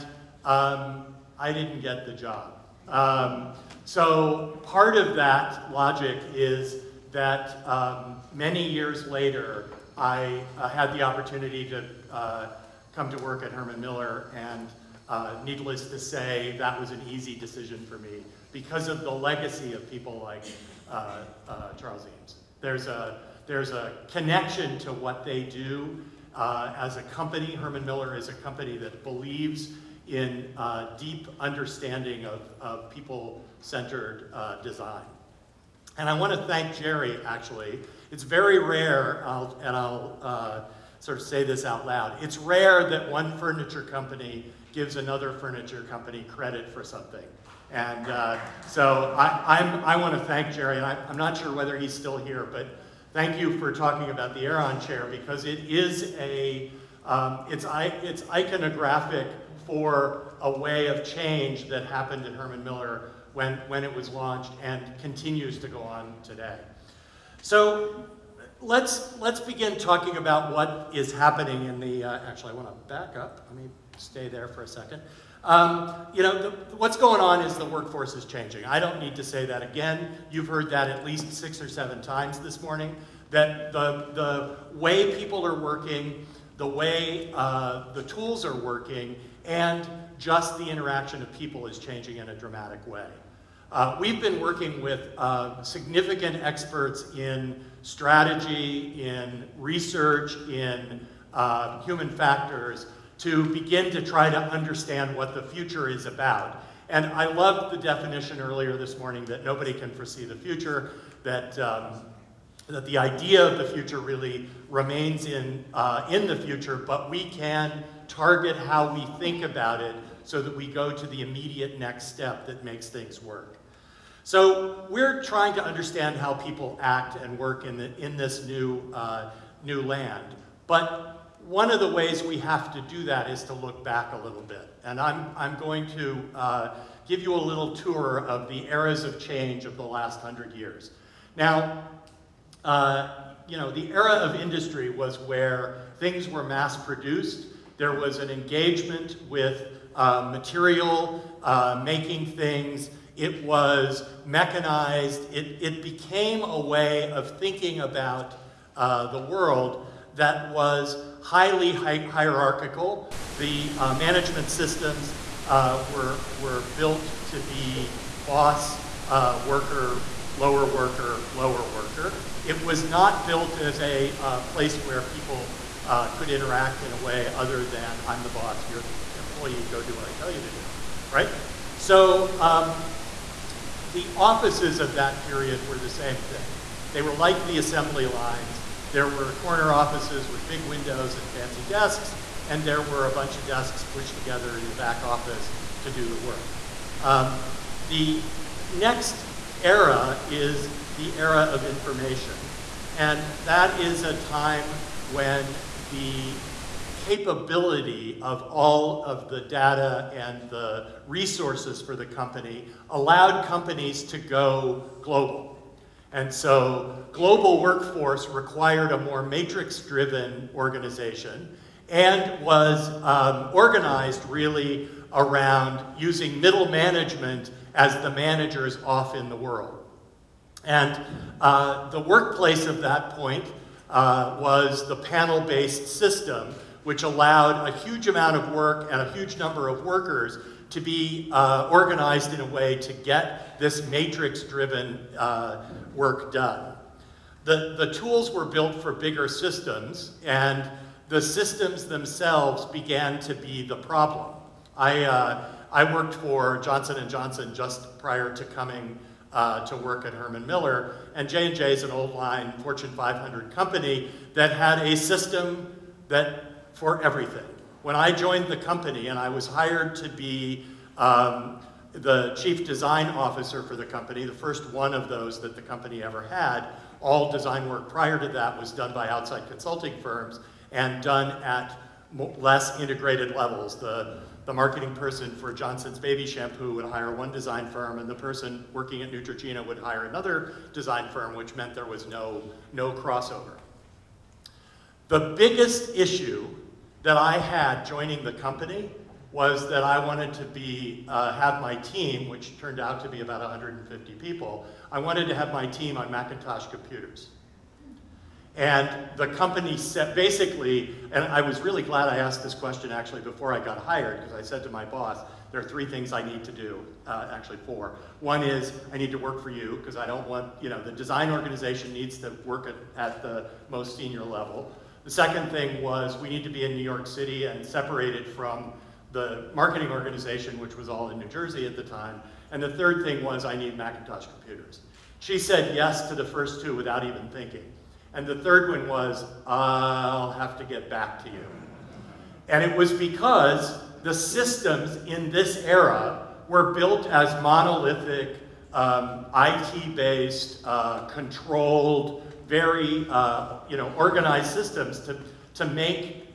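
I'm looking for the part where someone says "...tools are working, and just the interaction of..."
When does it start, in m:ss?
1:28.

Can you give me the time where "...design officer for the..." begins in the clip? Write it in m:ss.
4:32.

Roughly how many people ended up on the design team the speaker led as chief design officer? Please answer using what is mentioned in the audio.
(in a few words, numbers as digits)
150.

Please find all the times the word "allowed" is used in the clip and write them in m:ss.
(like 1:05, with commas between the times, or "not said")
3:32, 3:57.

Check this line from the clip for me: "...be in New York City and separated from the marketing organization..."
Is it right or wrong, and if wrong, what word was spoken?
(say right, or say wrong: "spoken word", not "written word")
right.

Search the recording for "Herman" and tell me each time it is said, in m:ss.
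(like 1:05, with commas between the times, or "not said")
0:13, 0:27, 1:02, 4:20.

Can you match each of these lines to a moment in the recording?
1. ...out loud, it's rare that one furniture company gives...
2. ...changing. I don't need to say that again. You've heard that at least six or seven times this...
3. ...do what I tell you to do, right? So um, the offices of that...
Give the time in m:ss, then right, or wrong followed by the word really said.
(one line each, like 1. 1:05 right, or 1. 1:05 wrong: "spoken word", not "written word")
1. 0:41 right
2. 1:18 right
3. 2:59 right.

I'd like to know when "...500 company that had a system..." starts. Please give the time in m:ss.
4:22.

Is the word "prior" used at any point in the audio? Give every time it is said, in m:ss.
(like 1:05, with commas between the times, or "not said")
4:17, 4:37.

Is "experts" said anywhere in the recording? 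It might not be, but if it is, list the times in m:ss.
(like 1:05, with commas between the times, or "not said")
1:36.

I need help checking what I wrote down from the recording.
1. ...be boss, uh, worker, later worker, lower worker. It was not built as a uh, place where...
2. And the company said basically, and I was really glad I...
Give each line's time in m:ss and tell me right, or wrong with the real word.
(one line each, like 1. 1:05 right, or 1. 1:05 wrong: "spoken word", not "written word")
1. 2:47 wrong: "lower", not "later"
2. 5:08 right.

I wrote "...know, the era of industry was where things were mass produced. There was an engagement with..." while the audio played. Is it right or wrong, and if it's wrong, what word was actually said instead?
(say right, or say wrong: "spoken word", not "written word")
right.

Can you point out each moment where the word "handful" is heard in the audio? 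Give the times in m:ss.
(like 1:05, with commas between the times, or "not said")
not said.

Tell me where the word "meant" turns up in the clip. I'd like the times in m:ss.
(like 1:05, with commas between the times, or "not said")
4:51.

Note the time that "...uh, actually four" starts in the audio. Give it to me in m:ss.
5:17.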